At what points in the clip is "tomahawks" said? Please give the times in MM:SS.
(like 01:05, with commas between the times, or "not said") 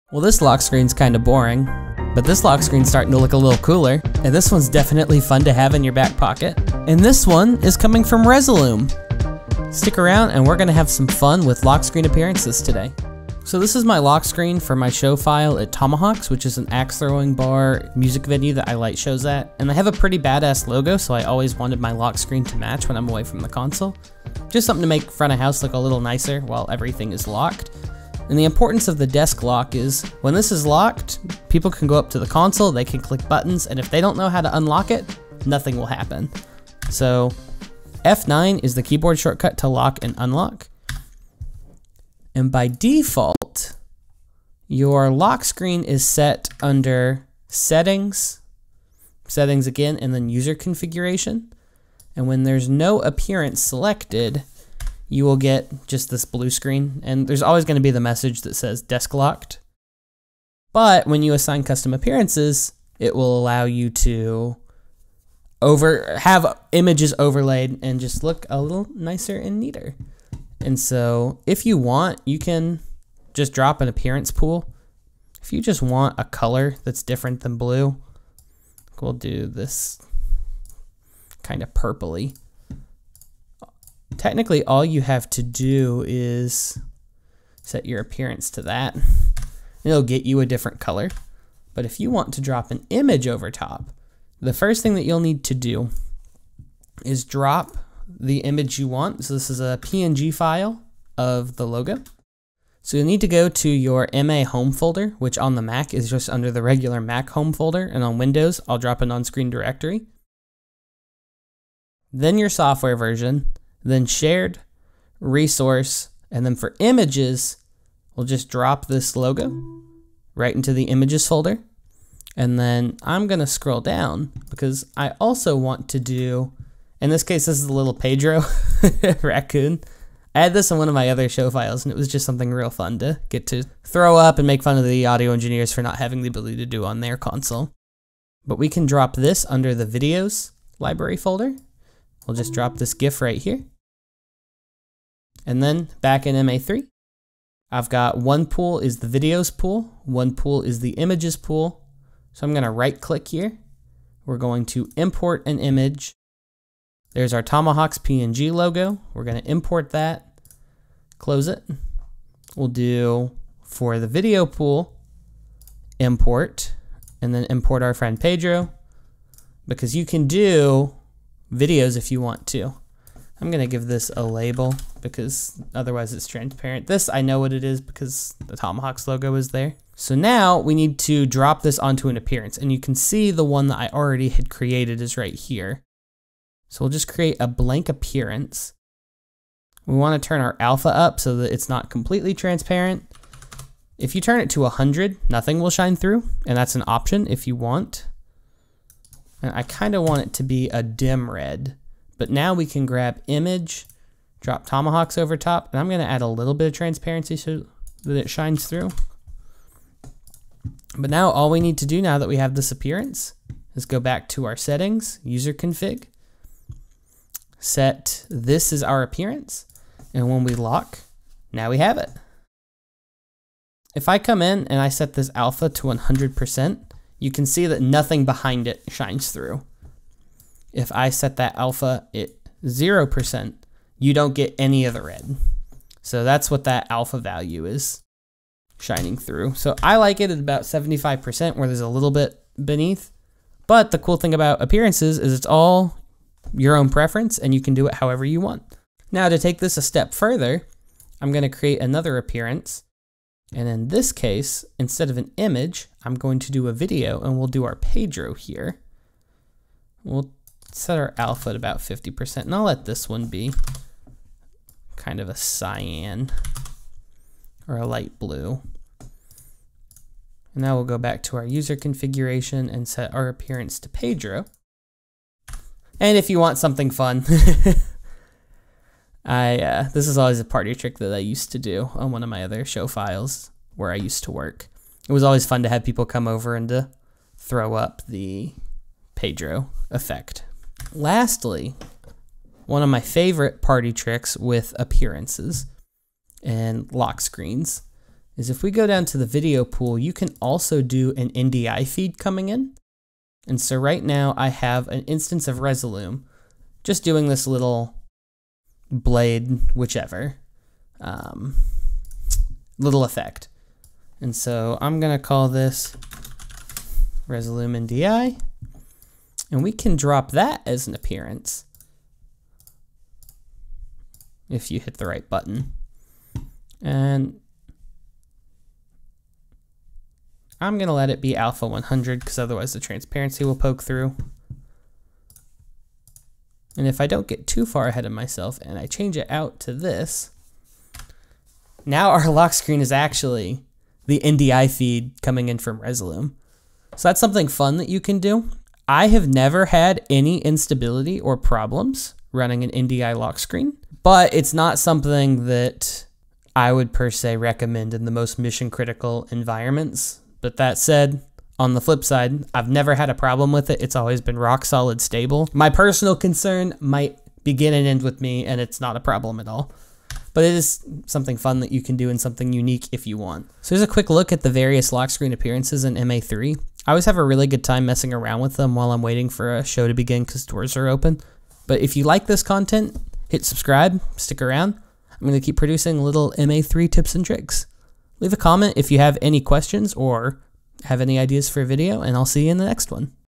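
00:15, 02:37, 02:58, 03:24.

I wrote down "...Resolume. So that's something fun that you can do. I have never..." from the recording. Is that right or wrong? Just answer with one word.
right.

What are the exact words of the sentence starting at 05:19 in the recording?
And we can drop that as an appearance if you hit the right button.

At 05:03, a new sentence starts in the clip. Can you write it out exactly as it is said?
And so right now I have an instance of Resolume just doing this little blade, whichever, um, little effect.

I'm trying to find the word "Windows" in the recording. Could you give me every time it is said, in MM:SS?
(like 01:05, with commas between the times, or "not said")
01:48.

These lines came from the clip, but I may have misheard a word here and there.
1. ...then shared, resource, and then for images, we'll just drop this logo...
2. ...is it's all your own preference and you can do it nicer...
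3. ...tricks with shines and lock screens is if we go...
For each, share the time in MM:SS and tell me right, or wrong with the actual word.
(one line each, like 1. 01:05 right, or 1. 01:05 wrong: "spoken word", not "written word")
1. 01:53 right
2. 04:05 wrong: "however", not "nicer"
3. 04:53 wrong: "appearances", not "shines".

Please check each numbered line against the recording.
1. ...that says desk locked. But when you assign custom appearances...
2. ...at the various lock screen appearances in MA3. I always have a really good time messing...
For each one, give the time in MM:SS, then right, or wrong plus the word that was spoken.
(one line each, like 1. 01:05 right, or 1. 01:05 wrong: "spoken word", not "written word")
1. 00:58 right
2. 06:14 right.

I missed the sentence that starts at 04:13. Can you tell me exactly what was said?
And in this case, instead of an image, I'm going to do a video and we'll do our Pedro here.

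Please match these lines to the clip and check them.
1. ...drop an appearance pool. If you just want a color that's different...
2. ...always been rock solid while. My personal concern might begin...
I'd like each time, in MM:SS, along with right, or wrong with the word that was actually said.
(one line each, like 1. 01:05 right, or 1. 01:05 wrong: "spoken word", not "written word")
1. 01:13 right
2. 06:03 wrong: "stable", not "while".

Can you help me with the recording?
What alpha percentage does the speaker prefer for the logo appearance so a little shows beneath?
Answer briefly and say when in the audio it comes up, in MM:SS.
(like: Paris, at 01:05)
75%, at 04:00.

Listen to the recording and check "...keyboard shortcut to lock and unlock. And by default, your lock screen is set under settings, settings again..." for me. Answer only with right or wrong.
right.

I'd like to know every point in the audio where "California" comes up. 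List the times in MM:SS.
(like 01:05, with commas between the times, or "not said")
not said.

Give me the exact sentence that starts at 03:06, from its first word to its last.
So we'll just create a blank appearance.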